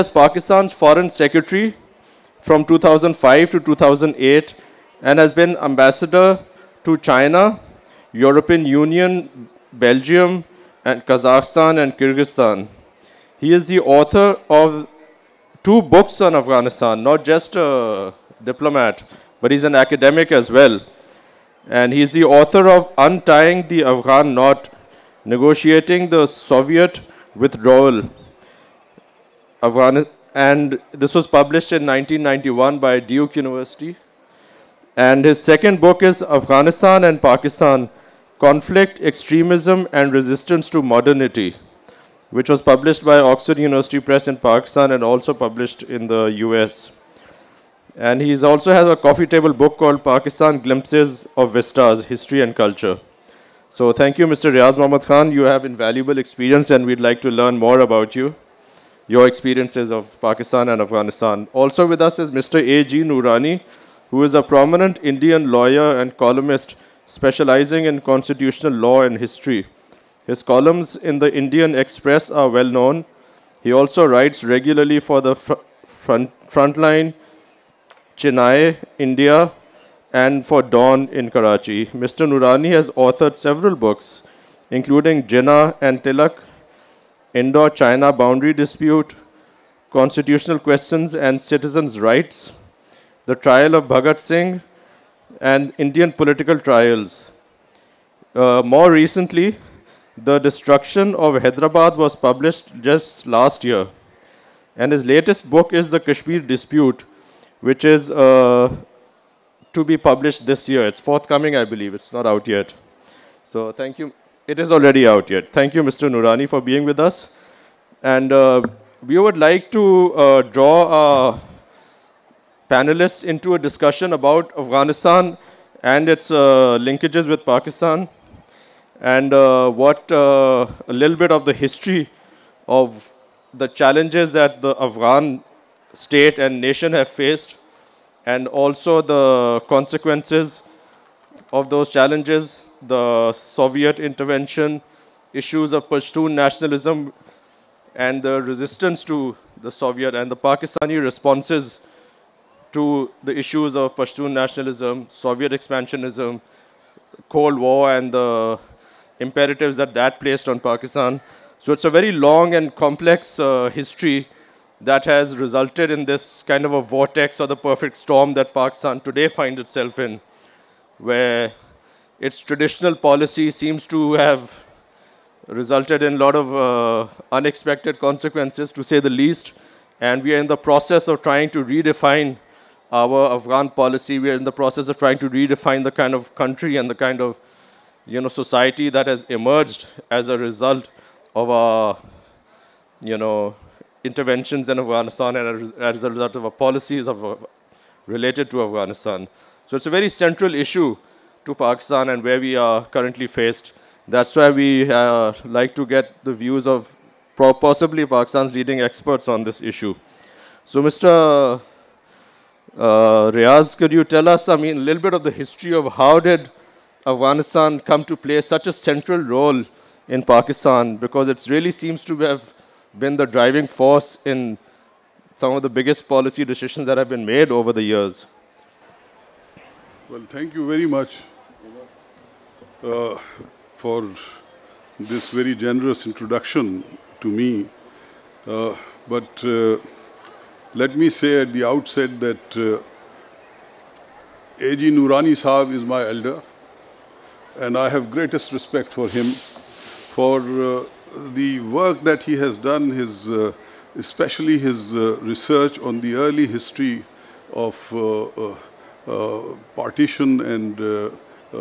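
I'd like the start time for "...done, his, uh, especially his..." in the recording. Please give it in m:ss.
4:12.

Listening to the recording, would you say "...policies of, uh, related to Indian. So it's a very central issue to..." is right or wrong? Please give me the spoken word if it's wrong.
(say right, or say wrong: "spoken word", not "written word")
wrong: "Afghanistan", not "Indian".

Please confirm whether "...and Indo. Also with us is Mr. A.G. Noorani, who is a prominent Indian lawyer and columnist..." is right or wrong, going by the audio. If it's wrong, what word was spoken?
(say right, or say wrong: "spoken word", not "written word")
wrong: "Afghanistan", not "Indo".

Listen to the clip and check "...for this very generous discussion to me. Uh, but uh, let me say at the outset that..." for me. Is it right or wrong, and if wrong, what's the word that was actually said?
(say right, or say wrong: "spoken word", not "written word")
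wrong: "introduction", not "discussion".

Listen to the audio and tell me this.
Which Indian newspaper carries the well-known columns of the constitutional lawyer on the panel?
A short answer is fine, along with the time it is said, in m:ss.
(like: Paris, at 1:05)
Indian Express, at 1:11.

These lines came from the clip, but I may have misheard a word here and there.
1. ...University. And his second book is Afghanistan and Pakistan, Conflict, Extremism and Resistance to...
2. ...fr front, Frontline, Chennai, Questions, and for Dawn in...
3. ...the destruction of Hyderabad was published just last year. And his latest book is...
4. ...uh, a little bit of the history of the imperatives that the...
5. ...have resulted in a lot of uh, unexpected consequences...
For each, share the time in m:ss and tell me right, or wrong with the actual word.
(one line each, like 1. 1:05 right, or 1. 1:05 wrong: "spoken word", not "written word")
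1. 0:33 right
2. 1:15 wrong: "India", not "Questions"
3. 1:40 right
4. 2:10 wrong: "challenges", not "imperatives"
5. 2:54 right.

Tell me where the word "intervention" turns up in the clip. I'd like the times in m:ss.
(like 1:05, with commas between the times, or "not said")
2:23, 3:14.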